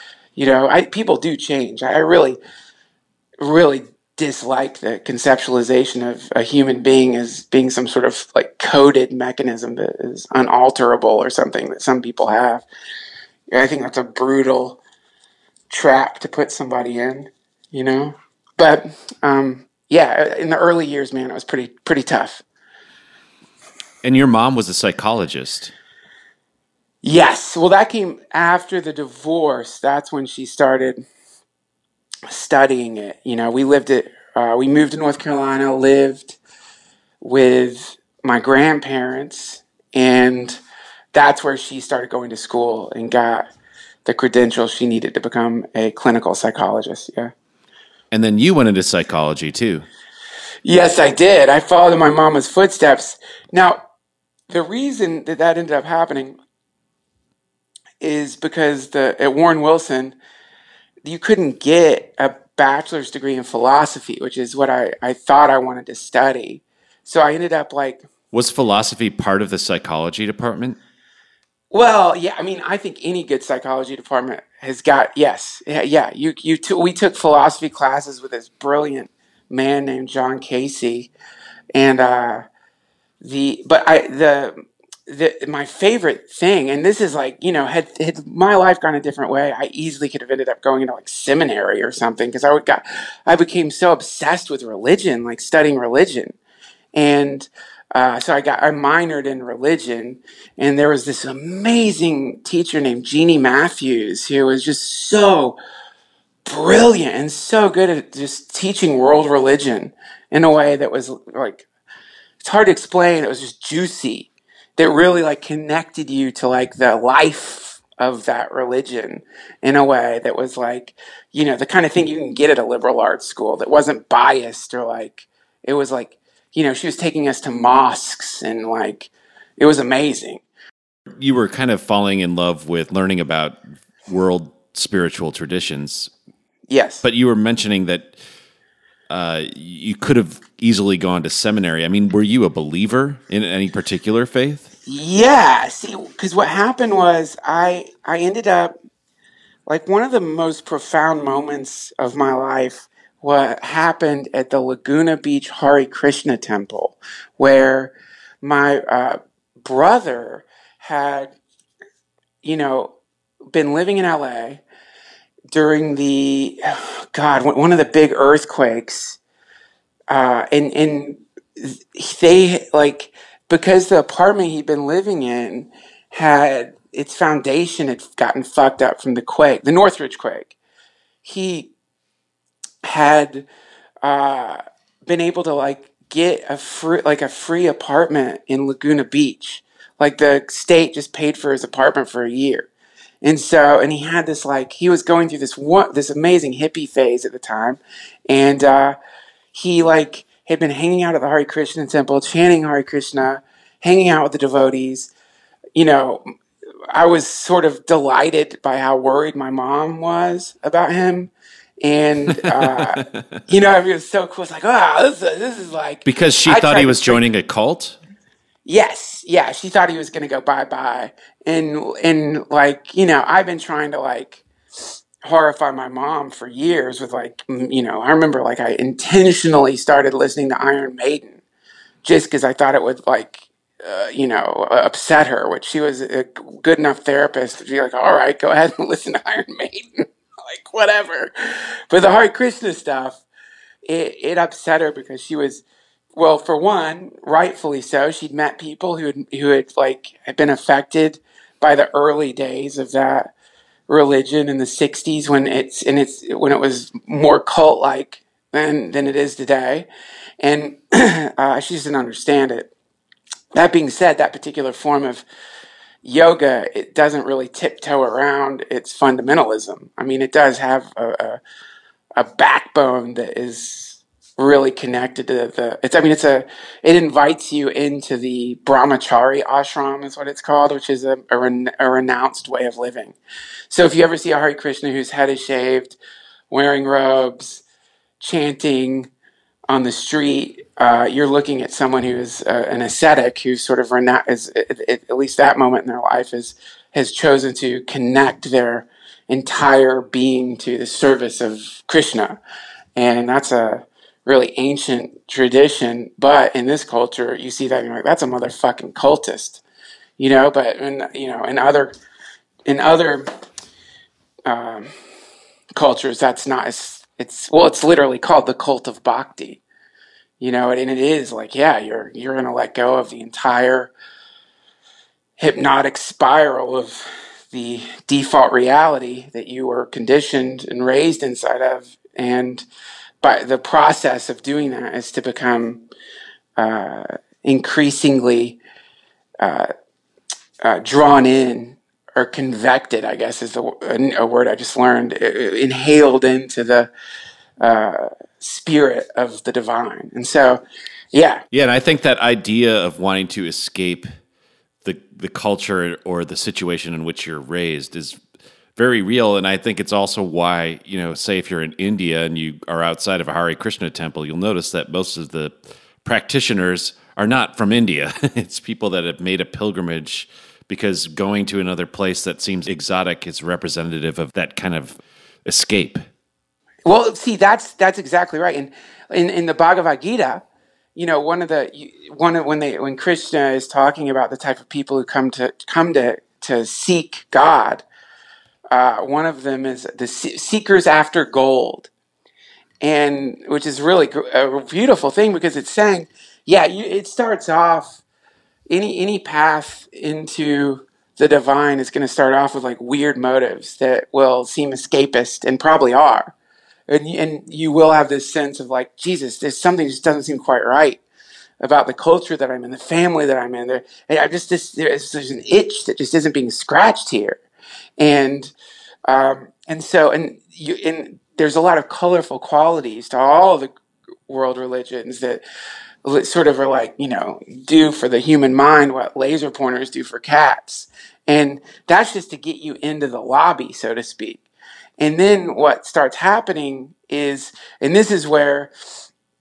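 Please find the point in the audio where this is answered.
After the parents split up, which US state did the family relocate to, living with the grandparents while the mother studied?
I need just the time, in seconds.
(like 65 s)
34 s.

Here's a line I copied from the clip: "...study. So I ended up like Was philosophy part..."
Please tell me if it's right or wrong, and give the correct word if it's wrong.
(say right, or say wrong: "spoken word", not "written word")
right.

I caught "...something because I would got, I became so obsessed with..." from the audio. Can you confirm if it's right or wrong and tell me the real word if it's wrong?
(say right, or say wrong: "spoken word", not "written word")
right.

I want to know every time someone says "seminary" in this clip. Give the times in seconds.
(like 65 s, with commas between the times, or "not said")
91 s, 141 s.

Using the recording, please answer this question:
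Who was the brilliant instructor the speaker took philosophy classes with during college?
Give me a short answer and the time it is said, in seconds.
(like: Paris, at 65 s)
John Casey, at 80 s.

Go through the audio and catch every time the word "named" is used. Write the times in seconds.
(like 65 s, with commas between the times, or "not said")
79 s, 102 s.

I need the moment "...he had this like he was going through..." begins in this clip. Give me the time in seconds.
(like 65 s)
193 s.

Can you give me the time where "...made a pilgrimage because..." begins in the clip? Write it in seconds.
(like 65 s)
369 s.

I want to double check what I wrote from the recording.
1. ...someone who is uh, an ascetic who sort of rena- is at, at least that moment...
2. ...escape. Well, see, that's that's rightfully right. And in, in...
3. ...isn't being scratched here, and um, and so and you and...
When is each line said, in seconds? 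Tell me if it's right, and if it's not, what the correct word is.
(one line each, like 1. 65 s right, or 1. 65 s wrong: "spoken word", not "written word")
1. 291 s right
2. 375 s wrong: "exactly", not "rightfully"
3. 416 s right.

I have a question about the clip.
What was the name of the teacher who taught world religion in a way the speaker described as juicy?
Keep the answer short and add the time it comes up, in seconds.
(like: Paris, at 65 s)
Jeannie Matthews, at 103 s.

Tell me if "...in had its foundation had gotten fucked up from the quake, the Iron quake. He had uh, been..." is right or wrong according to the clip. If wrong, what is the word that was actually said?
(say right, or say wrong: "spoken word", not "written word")
wrong: "Northridge", not "Iron".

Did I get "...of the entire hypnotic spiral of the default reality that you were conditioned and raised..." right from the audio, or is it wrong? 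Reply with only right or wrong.
right.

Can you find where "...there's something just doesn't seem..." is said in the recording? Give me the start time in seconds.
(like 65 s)
409 s.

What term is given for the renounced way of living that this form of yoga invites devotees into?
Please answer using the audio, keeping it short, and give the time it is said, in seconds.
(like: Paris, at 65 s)
brahmachari ashram, at 278 s.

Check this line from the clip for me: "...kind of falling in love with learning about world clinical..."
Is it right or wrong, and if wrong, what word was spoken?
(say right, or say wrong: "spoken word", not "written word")
wrong: "spiritual", not "clinical".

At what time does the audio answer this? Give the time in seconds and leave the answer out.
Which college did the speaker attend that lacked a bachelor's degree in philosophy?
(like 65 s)
59 s.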